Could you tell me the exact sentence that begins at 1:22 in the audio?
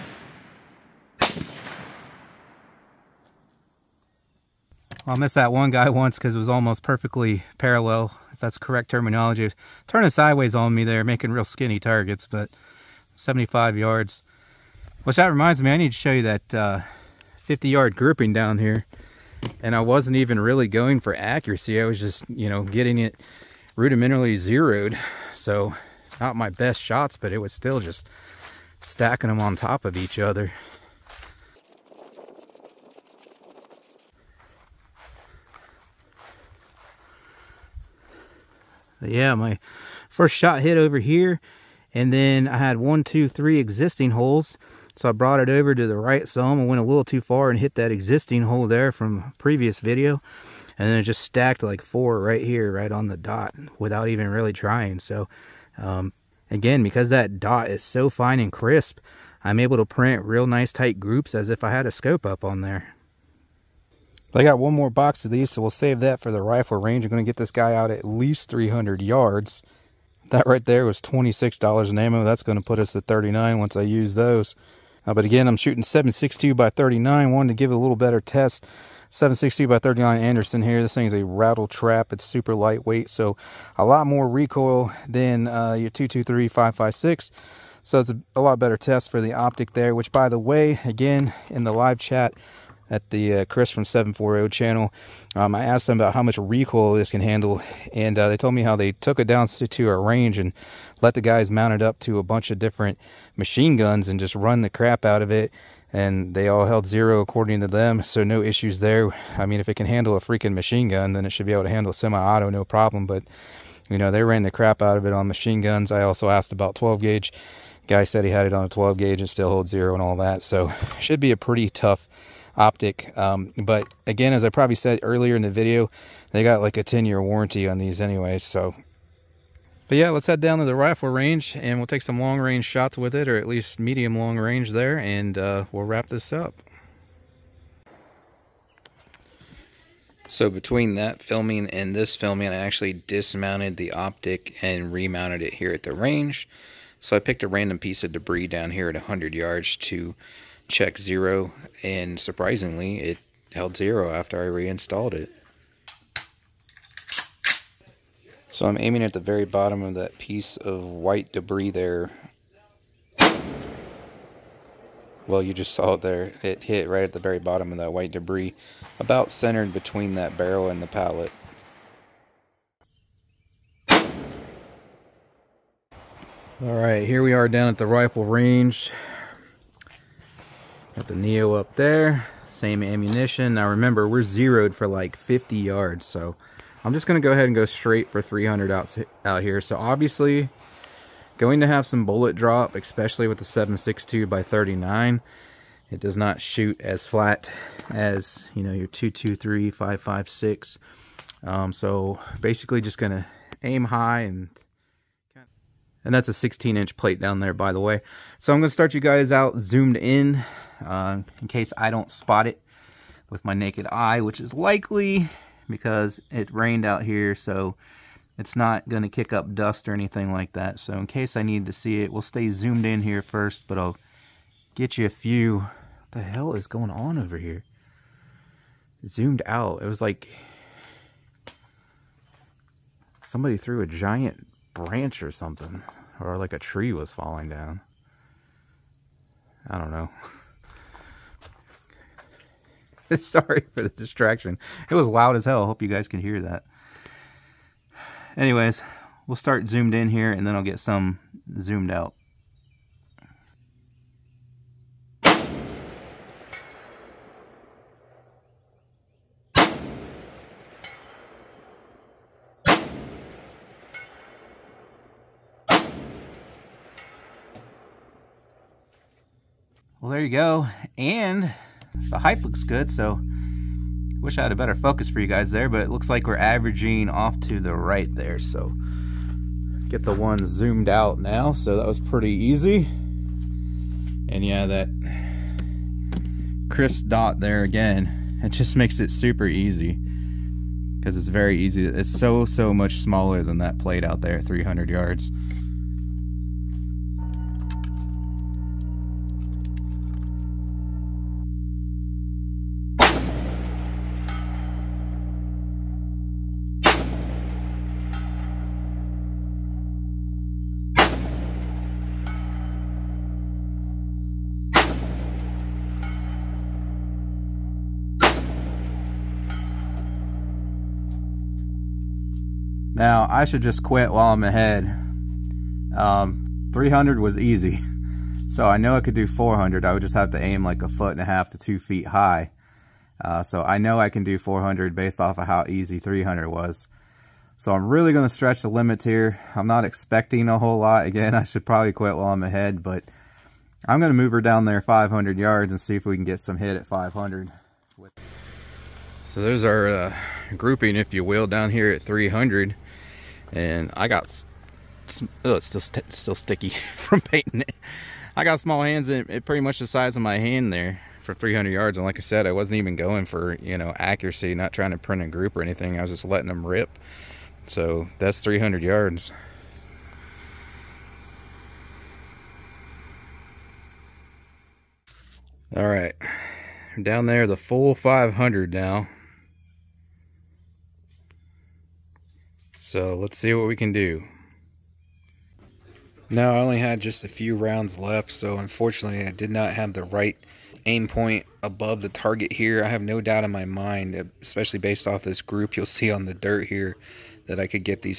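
It's super lightweight, so a lot more recoil than uh, your 223 556.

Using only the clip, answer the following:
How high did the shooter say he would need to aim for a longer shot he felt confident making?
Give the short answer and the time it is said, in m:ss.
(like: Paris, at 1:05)
a foot and a half to two feet, at 5:30.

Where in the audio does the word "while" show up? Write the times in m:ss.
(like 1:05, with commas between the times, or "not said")
5:24, 5:42.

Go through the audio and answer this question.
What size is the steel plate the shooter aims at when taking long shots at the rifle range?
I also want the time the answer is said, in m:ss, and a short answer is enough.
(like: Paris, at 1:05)
16 inch, at 3:26.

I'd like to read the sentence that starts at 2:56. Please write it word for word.
All right, here we are down at the rifle range.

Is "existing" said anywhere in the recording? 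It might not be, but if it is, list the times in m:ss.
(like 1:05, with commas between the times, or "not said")
0:43, 0:47.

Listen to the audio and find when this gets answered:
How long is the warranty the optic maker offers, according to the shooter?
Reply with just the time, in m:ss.
2:06.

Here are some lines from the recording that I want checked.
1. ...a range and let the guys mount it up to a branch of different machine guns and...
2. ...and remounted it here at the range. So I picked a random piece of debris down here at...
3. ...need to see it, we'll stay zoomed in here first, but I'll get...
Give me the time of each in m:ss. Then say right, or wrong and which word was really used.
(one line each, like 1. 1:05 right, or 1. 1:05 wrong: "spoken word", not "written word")
1. 1:39 wrong: "bunch", not "branch"
2. 2:24 right
3. 3:41 right.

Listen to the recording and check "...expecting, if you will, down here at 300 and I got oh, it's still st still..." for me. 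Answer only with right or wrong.
wrong.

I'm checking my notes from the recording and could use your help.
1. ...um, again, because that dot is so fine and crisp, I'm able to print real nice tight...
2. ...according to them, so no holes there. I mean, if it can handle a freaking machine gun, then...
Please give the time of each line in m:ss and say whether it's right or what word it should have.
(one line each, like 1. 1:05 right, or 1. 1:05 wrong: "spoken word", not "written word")
1. 0:55 right
2. 1:47 wrong: "issues", not "holes".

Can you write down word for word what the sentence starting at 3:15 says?
It does not shoot as flat as, you know, your 223, 556.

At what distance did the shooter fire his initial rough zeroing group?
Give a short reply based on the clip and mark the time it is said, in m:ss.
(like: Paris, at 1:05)
50 yards, at 0:17.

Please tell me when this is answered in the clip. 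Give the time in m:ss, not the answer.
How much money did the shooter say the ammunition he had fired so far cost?
1:11.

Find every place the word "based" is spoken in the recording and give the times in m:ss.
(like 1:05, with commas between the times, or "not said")
5:34, 6:34.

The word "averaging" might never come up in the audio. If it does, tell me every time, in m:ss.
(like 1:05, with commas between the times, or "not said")
4:36.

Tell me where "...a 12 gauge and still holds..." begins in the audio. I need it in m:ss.
1:58.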